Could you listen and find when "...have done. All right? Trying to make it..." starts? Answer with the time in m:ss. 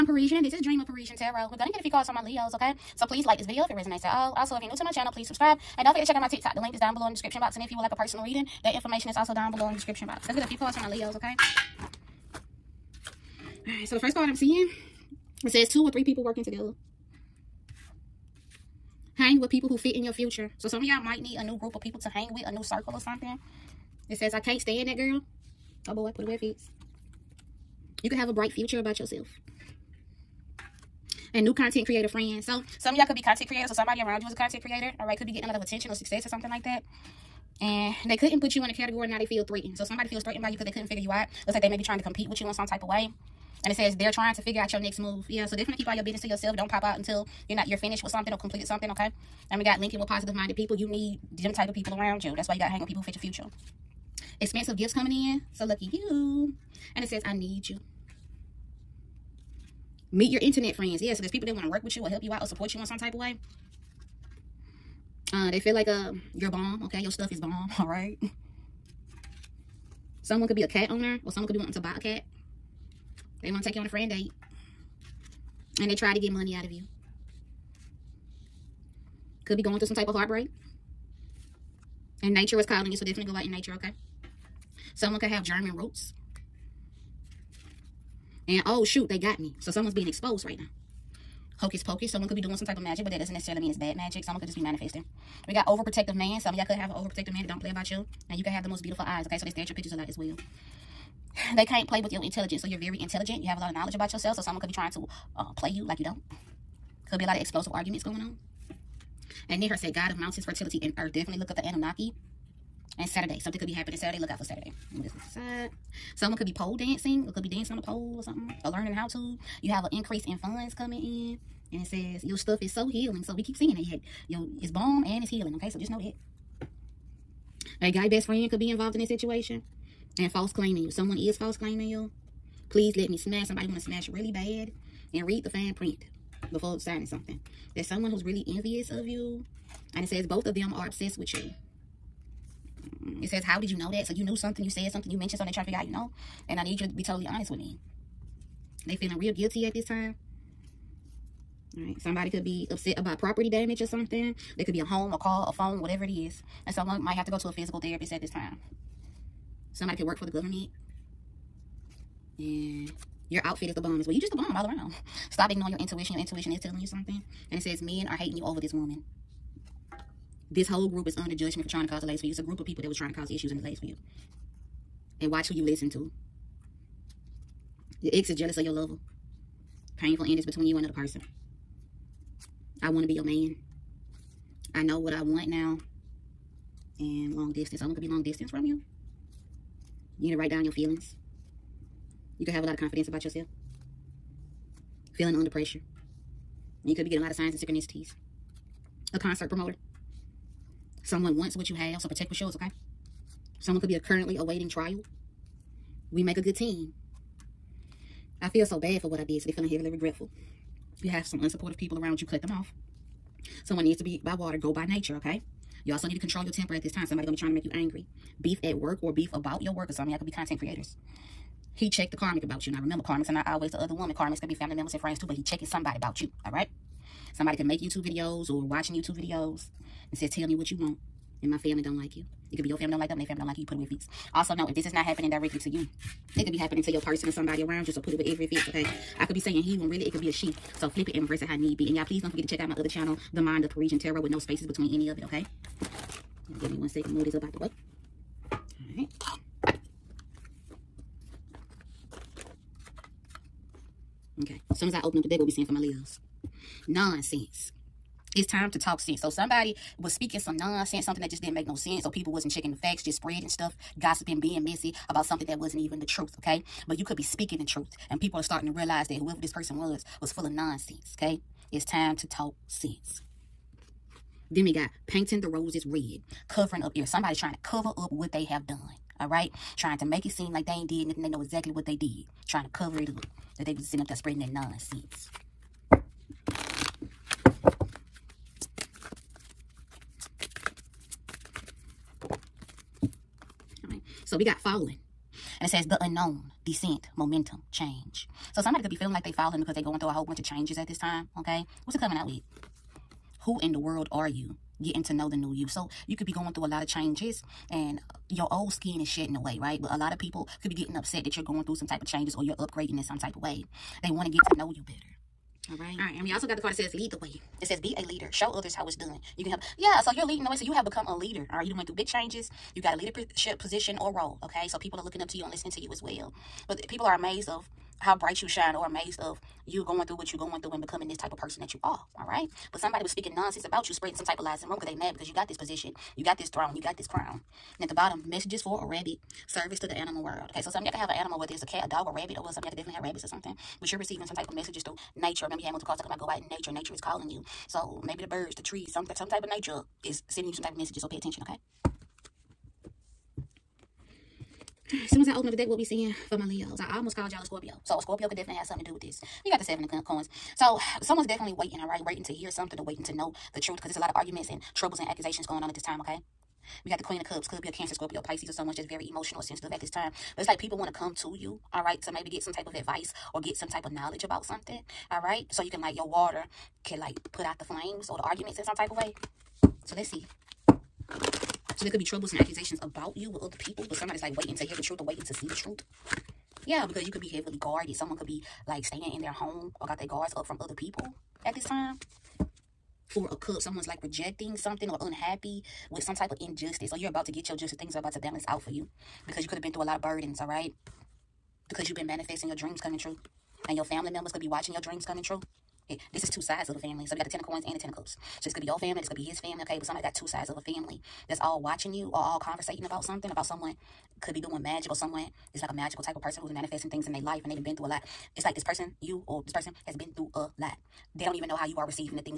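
4:38.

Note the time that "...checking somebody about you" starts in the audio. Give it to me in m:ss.
3:45.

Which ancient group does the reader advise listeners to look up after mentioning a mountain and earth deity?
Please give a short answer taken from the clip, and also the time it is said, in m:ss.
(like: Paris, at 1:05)
the Anunnaki, at 1:51.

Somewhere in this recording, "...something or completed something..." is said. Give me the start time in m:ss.
0:48.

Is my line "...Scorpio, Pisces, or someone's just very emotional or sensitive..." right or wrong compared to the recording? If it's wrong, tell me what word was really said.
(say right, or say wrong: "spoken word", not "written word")
right.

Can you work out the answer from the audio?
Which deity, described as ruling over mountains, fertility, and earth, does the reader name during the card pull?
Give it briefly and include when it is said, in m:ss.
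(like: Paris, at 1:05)
Ninhursag, at 1:49.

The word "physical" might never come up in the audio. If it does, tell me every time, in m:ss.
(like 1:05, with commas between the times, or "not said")
2:37.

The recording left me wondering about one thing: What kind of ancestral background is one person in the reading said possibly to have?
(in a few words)
German roots.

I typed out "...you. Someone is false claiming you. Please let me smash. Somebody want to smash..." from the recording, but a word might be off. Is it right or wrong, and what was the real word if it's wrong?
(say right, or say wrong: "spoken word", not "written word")
right.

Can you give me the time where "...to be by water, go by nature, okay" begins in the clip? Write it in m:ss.
3:33.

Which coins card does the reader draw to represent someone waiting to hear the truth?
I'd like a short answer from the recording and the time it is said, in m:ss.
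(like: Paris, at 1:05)
Seven of Coins, at 5:59.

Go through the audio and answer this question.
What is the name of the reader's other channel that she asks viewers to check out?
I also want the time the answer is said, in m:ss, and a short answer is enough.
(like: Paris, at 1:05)
The Mind of Parrisenne Tarot, at 4:03.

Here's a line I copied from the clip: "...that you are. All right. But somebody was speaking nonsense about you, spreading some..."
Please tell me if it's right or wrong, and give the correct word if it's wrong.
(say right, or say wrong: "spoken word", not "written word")
right.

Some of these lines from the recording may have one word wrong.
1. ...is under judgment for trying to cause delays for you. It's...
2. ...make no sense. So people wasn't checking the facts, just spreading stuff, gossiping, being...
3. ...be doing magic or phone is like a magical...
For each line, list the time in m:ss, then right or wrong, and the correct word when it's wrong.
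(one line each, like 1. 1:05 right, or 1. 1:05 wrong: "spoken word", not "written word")
1. 2:51 right
2. 4:21 right
3. 6:54 wrong: "someone", not "phone".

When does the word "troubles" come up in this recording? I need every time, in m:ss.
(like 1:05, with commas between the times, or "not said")
6:04, 6:22.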